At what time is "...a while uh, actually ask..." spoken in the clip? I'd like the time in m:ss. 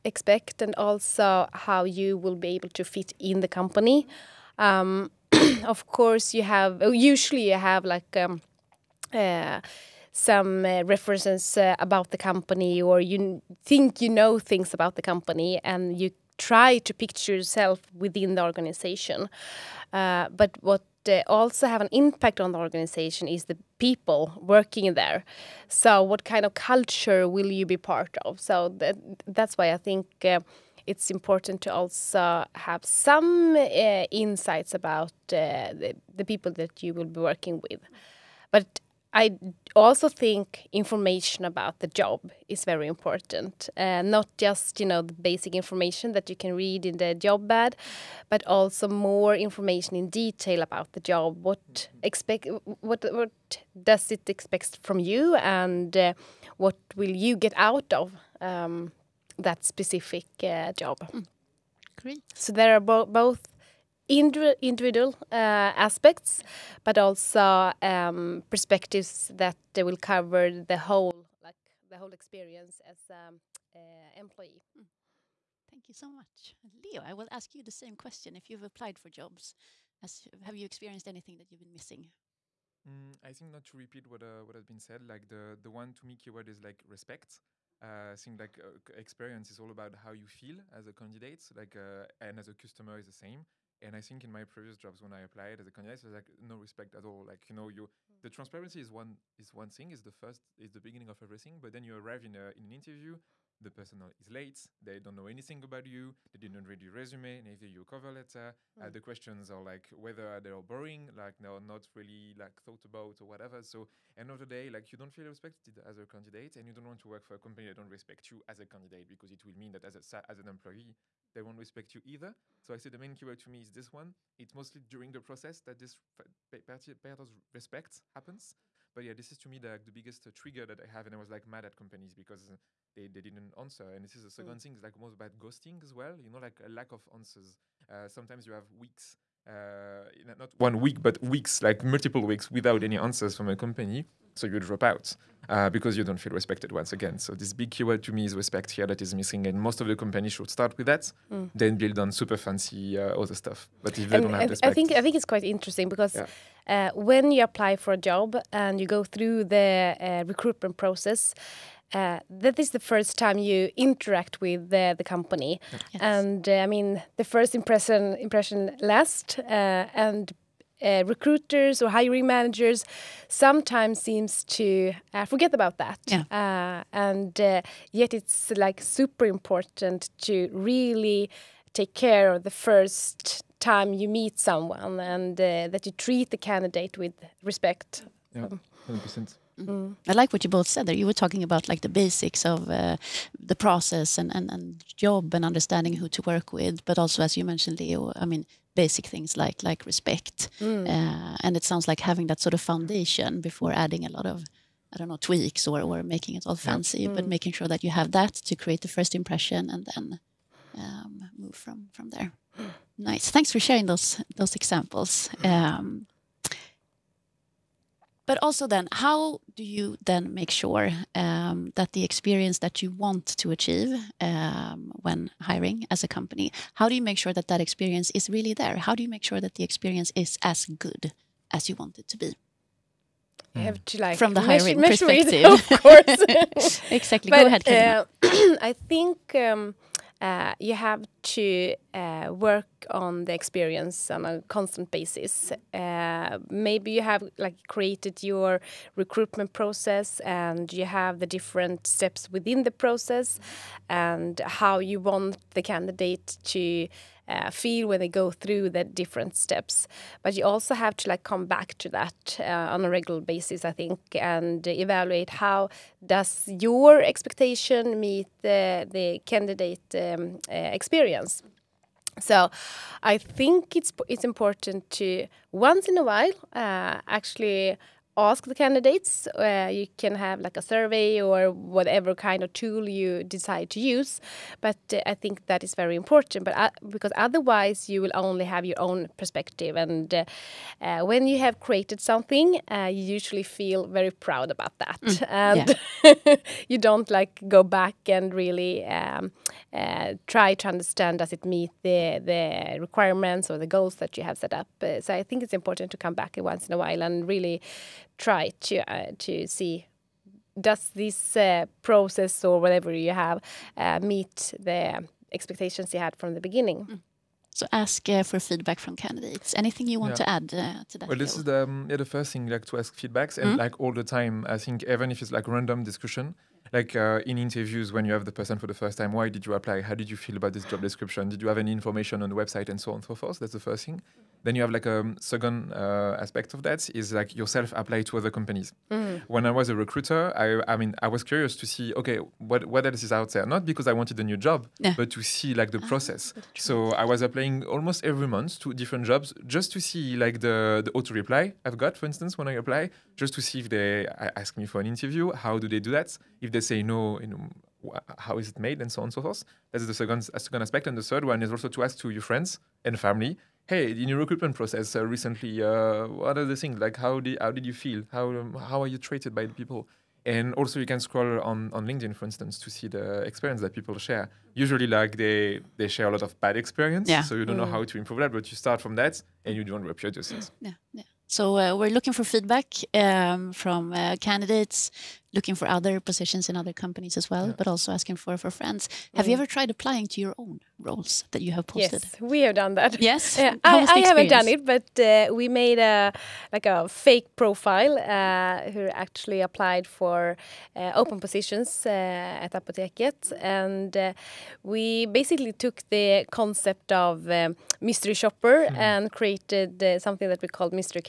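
4:35.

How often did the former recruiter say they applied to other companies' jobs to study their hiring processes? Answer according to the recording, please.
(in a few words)
Almost every month.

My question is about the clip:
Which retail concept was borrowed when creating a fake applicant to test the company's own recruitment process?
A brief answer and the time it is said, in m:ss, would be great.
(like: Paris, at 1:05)
Mystery shopper, at 6:47.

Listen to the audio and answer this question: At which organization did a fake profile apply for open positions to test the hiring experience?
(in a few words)
Apoteket.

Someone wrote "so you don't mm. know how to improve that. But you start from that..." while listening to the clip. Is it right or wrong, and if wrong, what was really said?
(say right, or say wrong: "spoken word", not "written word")
right.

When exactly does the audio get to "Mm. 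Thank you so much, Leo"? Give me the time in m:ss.
1:14.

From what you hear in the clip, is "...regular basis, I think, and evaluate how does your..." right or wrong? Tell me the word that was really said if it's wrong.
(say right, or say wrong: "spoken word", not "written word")
right.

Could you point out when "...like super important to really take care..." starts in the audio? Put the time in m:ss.
2:58.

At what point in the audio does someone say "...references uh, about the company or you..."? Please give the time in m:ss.
0:10.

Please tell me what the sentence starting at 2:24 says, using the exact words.
So you drop out uh, because you don't feel respected once again.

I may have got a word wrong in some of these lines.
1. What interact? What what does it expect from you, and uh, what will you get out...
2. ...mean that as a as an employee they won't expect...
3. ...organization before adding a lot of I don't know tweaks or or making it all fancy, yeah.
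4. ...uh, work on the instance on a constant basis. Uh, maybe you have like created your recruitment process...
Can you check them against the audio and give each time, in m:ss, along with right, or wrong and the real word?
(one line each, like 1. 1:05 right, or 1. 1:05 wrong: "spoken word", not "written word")
1. 0:51 wrong: "expect", not "interact"
2. 1:59 wrong: "respect", not "expect"
3. 3:22 wrong: "foundation", not "organization"
4. 4:01 wrong: "experience", not "instance".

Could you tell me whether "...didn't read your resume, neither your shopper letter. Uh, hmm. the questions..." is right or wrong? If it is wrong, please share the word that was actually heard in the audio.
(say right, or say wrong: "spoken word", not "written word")
wrong: "cover", not "shopper".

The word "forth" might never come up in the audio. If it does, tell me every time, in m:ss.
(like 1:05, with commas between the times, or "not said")
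5:33, 5:59.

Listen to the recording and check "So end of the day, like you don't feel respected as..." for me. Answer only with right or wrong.
right.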